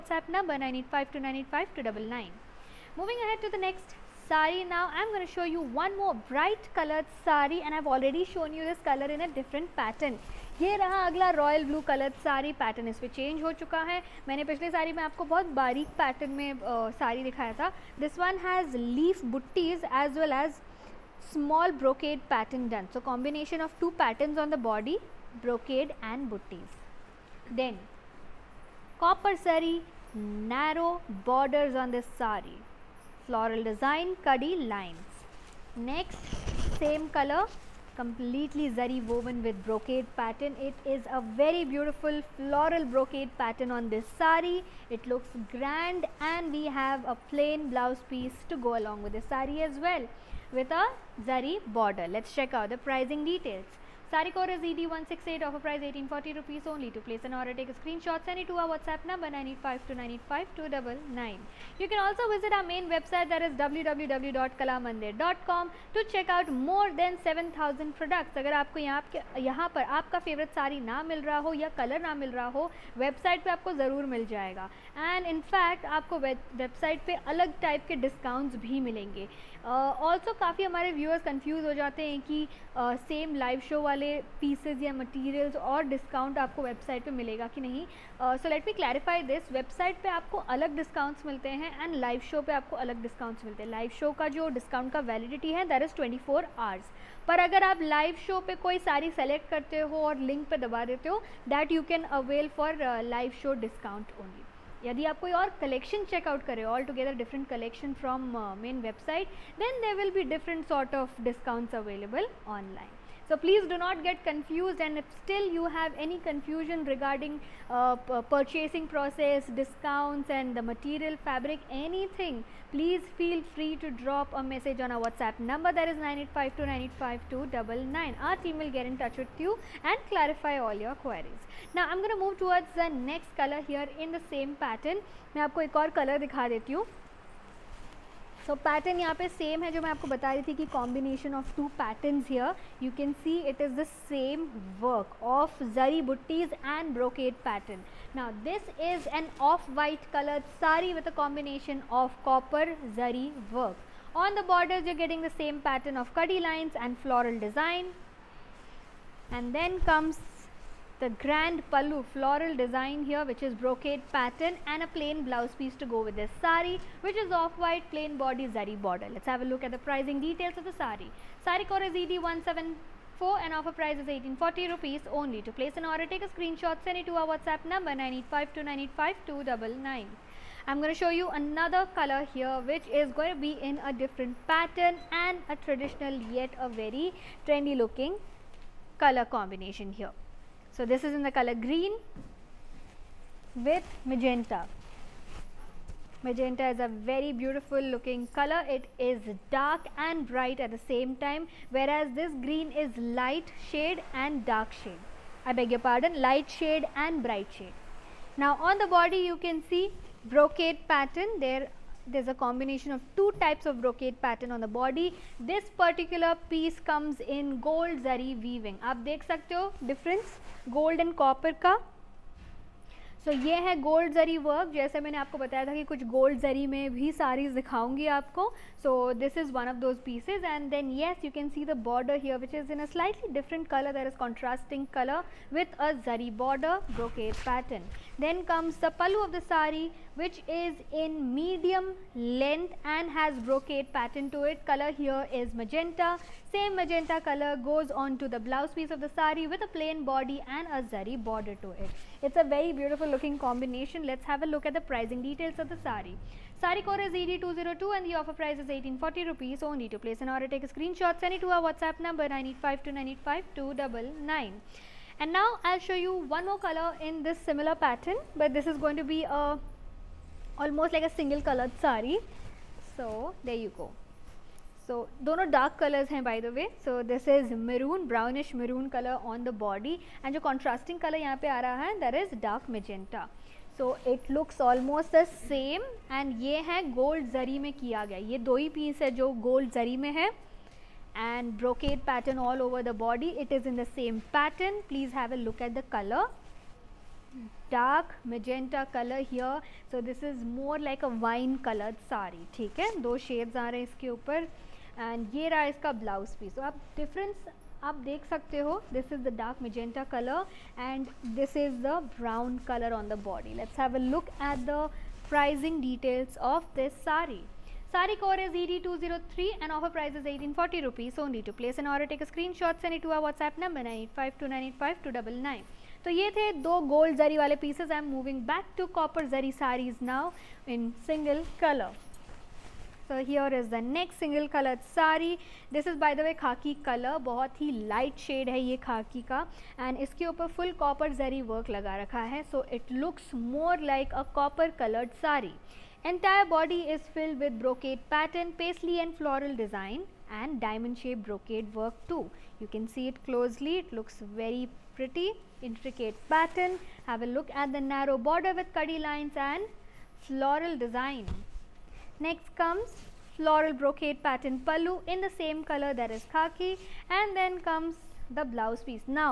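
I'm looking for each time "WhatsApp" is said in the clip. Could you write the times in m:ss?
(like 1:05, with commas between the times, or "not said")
0:58, 2:05, 2:57, 4:21, 5:23.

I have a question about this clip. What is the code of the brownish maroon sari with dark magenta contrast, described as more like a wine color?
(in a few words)
ED203.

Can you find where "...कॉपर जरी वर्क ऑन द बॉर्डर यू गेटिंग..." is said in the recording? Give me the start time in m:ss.
2:32.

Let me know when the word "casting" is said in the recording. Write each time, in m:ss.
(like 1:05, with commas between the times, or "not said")
not said.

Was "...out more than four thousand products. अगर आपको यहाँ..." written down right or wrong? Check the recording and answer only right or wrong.
wrong.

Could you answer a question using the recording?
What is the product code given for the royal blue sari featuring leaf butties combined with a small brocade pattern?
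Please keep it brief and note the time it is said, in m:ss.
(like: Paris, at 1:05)
ED168, at 0:54.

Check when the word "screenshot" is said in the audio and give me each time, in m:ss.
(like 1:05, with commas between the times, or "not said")
0:57, 2:56, 4:20, 5:22.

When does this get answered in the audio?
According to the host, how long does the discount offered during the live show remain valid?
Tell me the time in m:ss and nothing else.
1:35.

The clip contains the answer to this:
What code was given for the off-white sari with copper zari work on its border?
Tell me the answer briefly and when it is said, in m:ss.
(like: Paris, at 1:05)
ED174, at 2:51.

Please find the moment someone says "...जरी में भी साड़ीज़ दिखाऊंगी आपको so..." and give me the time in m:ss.
3:46.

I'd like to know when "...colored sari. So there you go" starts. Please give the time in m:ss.
4:31.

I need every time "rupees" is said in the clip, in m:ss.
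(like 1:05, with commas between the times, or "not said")
0:56, 2:54, 4:19, 5:20.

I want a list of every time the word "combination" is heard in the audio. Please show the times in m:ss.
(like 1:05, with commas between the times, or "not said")
0:23, 3:09, 3:32, 4:13.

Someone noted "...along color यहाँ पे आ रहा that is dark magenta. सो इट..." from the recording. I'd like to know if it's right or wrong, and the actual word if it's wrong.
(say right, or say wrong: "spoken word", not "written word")
wrong: "contrasting", not "along".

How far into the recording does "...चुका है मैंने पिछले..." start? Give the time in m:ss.
0:13.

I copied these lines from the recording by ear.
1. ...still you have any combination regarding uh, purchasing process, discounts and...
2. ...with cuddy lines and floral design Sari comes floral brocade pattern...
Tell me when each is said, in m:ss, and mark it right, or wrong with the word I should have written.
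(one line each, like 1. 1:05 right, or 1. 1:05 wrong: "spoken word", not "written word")
1. 1:55 wrong: "confusion", not "combination"
2. 5:58 wrong: "Next", not "Sari".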